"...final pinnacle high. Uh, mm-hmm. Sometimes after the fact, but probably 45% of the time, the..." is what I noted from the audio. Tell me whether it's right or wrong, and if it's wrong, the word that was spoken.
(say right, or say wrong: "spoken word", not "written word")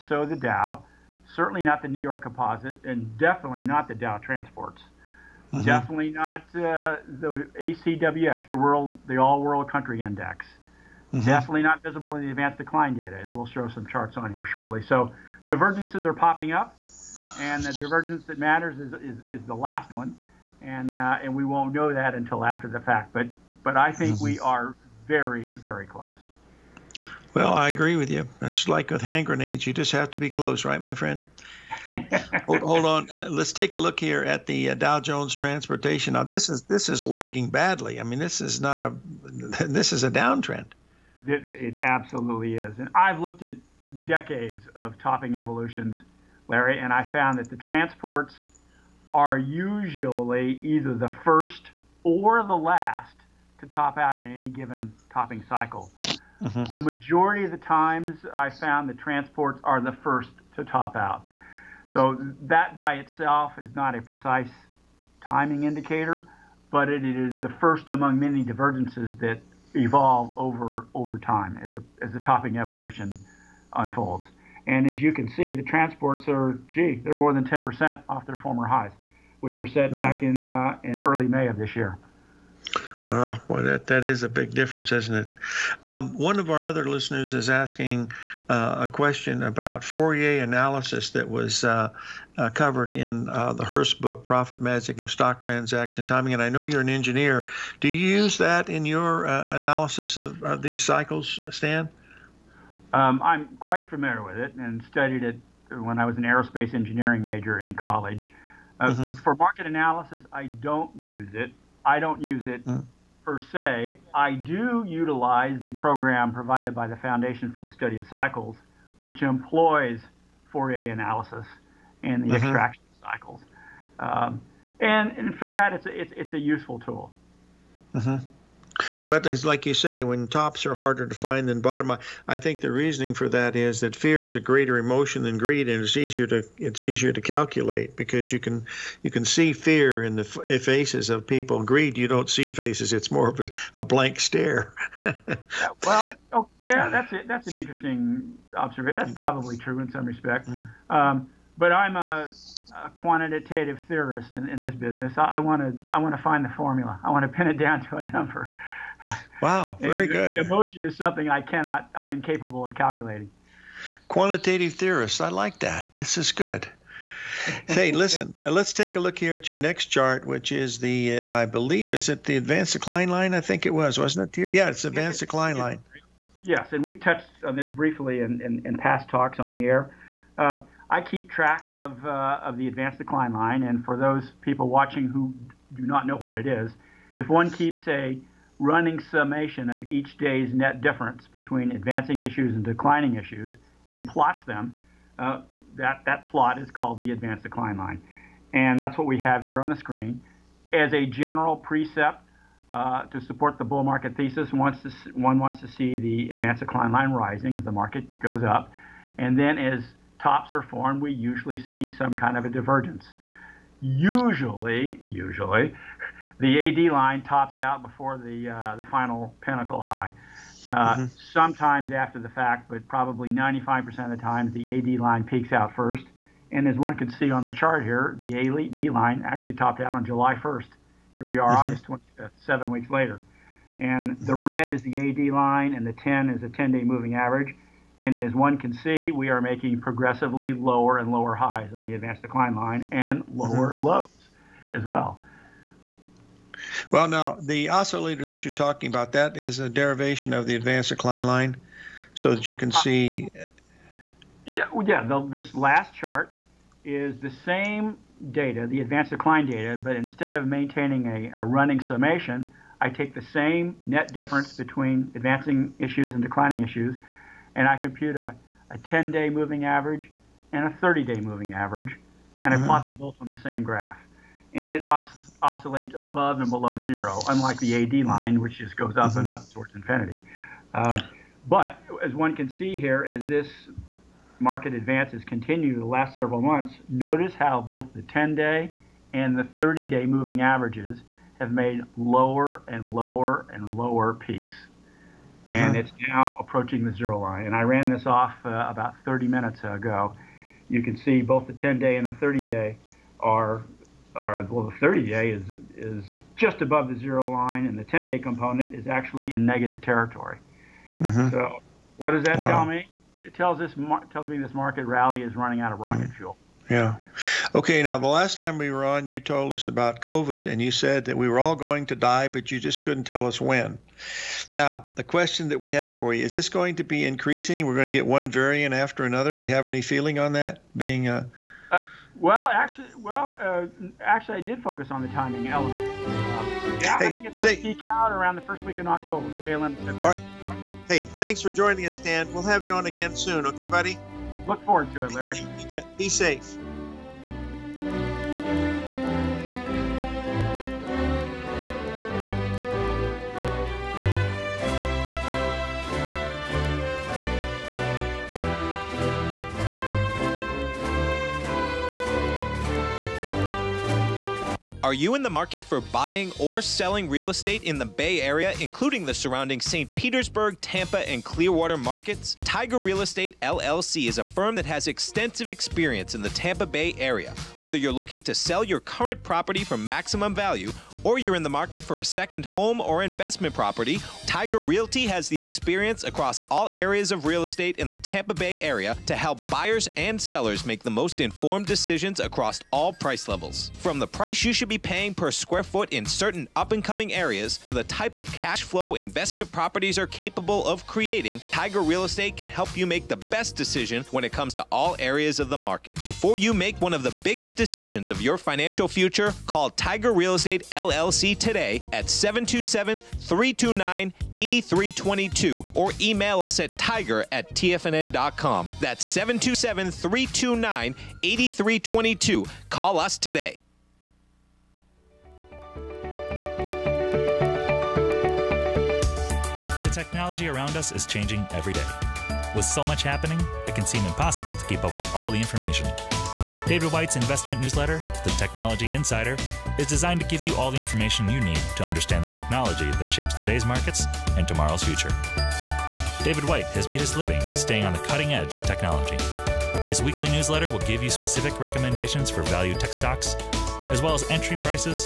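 wrong: "95", not "45".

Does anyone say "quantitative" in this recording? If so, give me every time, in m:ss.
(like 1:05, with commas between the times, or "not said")
2:32, 2:44.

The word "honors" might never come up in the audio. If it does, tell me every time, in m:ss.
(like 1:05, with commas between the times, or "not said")
not said.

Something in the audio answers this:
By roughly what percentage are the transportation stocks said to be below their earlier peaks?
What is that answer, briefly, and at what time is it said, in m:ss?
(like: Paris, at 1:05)
10%, at 1:17.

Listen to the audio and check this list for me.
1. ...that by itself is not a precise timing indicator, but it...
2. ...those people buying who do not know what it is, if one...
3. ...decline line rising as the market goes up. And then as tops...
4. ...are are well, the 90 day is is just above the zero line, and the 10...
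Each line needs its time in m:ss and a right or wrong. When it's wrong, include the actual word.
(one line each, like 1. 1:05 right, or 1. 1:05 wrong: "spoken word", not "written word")
1. 1:02 right
2. 3:03 wrong: "watching", not "buying"
3. 3:26 right
4. 5:03 wrong: "30", not "90".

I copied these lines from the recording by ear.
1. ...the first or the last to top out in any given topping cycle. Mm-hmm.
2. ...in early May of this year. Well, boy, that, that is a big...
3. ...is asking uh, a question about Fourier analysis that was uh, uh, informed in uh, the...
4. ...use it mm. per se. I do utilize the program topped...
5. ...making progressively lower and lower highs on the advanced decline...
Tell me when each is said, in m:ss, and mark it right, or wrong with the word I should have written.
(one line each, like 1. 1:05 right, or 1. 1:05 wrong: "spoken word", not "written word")
1. 0:50 right
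2. 1:20 right
3. 1:27 wrong: "covered", not "informed"
4. 1:52 wrong: "provided", not "topped"
5. 3:59 right.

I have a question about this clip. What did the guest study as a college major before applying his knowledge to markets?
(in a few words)
Aerospace engineering.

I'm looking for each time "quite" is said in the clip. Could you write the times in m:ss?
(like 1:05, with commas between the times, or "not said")
1:43.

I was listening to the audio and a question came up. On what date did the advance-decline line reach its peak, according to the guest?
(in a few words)
July 1.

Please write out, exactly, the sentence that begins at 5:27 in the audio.
We're going to get one variant after another.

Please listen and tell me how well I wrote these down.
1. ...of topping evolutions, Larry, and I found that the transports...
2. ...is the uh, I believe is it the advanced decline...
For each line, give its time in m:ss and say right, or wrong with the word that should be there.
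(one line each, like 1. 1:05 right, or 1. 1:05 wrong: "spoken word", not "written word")
1. 0:44 right
2. 2:50 right.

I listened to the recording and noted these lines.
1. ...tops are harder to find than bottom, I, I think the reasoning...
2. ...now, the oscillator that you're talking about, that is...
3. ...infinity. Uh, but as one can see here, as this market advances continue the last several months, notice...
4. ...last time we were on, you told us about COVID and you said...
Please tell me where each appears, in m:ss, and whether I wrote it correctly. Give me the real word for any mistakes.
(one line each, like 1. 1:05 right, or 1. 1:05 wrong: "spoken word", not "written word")
1. 2:10 right
2. 4:07 right
3. 4:39 right
4. 5:18 right.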